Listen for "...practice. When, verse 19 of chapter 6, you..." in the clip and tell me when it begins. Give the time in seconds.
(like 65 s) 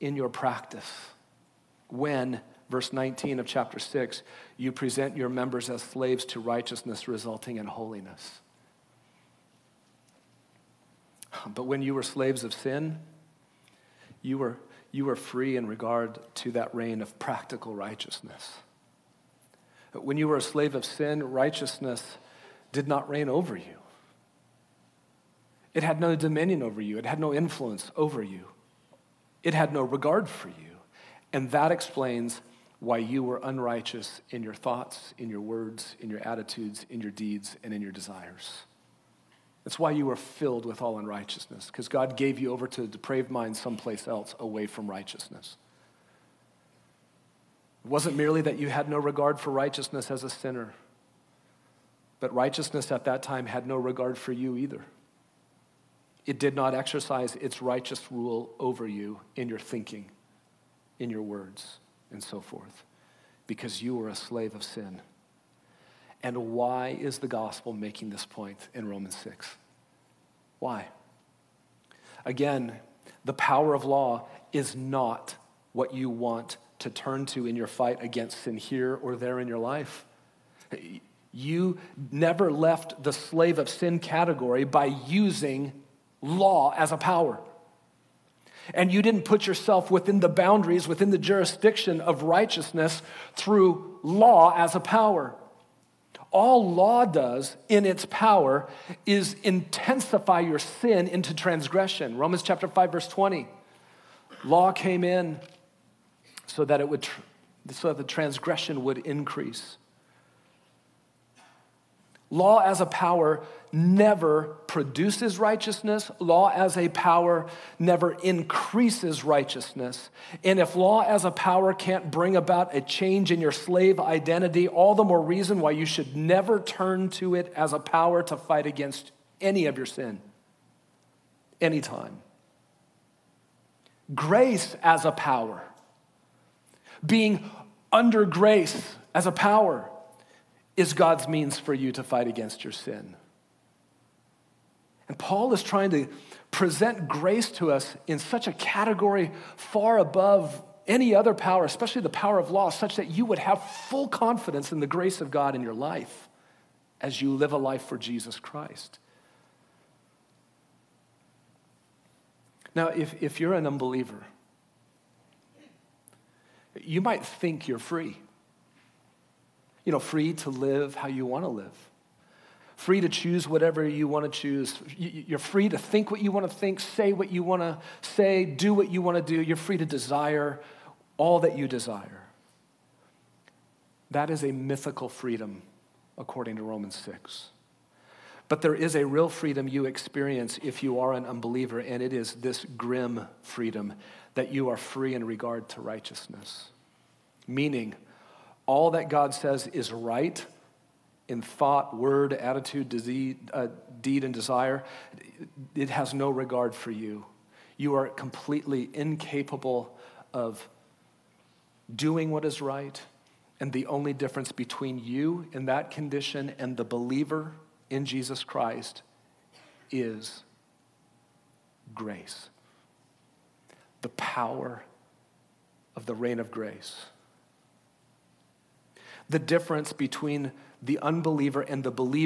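0 s.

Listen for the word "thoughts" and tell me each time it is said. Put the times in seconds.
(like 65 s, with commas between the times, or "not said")
34 s, 201 s.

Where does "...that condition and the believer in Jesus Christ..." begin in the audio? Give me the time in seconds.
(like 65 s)
215 s.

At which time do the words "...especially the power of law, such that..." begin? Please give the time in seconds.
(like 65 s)
151 s.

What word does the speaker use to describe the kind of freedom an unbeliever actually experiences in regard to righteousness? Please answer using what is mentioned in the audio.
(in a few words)
Grim.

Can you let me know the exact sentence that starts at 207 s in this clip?
You are completely incapable of doing what is right.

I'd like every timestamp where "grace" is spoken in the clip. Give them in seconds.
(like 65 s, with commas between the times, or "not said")
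134 s, 138 s, 147 s, 154 s, 221 s, 226 s.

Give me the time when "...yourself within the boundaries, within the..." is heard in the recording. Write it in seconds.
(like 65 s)
89 s.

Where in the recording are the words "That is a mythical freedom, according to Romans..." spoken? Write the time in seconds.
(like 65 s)
184 s.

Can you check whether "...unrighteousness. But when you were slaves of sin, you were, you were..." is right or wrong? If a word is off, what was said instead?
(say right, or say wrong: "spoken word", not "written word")
wrong: "holiness", not "unrighteousness".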